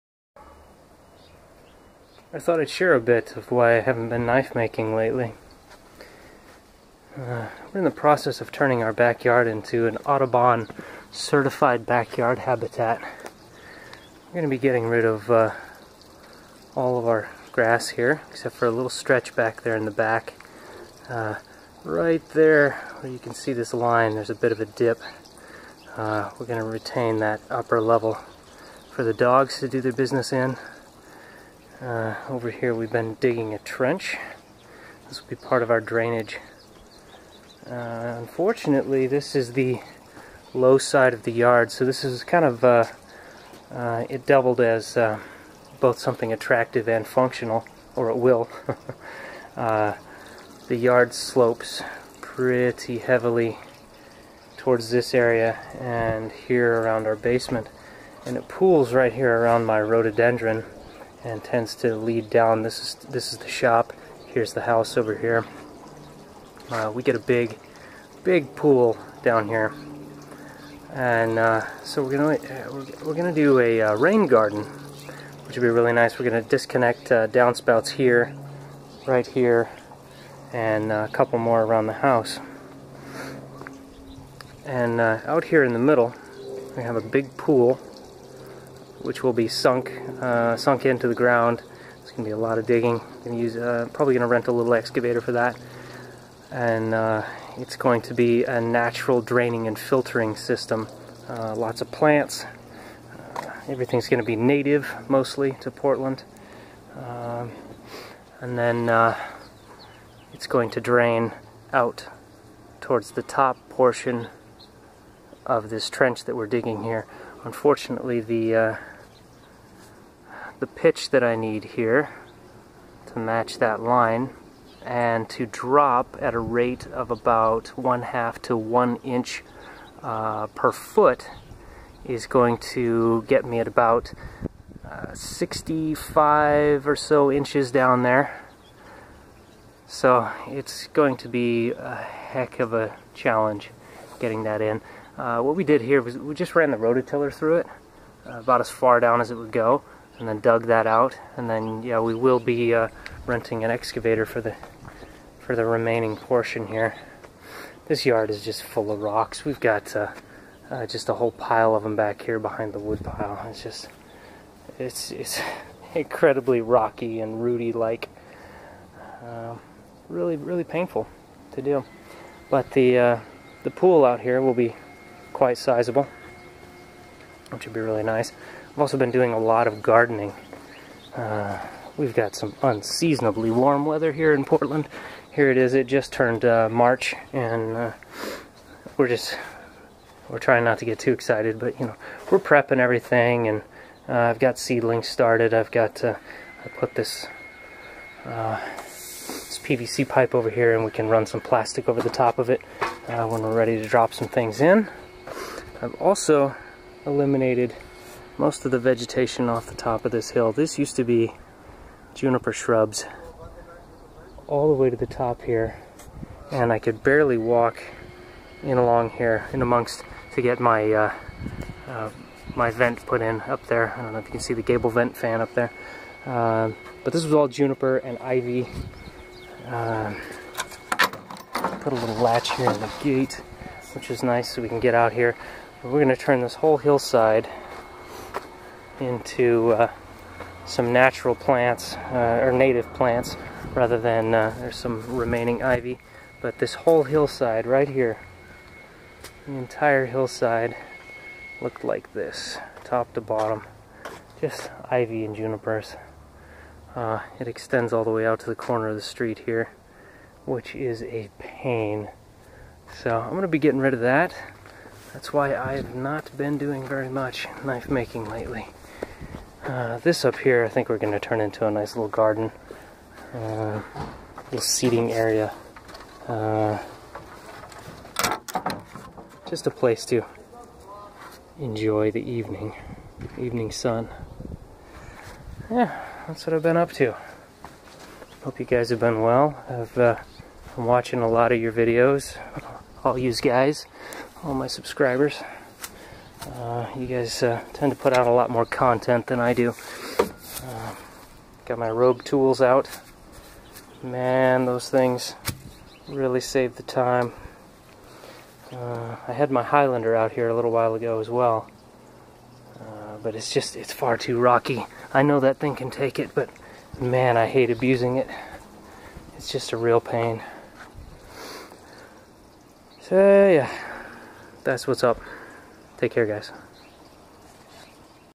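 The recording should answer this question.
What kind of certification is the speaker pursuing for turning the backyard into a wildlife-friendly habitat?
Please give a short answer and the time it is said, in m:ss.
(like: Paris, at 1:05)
Audubon, at 0:10.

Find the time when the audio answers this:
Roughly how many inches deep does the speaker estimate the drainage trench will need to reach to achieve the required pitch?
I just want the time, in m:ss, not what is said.
2:15.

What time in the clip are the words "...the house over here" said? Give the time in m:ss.
1:04.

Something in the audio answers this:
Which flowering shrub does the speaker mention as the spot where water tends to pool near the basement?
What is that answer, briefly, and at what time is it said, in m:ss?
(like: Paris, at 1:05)
rhododendron, at 0:59.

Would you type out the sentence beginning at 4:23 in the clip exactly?
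So I'm going to be getting rid of that.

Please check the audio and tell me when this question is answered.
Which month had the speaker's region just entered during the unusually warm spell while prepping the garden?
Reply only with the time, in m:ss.
3:06.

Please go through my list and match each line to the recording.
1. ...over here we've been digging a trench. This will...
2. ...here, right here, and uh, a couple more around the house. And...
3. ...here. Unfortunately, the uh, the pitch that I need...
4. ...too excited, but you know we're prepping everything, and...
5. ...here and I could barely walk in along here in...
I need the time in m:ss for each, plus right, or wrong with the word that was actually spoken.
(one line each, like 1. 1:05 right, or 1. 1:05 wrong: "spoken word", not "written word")
1. 0:32 right
2. 1:17 right
3. 1:56 right
4. 3:10 right
5. 3:35 right.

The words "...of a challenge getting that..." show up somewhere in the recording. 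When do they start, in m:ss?
2:22.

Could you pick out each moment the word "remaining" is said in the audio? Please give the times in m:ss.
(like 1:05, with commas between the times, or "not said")
2:35, 4:05.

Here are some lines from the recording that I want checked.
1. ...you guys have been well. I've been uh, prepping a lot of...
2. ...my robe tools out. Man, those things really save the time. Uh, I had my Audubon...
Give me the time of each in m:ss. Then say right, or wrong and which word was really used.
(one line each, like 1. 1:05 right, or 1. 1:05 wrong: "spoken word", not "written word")
1. 4:48 wrong: "watching", not "prepping"
2. 5:01 wrong: "Highlander", not "Audubon".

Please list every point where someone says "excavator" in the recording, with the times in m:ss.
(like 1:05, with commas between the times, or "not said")
1:34, 2:33.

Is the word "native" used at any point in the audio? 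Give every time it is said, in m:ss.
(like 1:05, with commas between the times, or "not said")
1:44, 4:02.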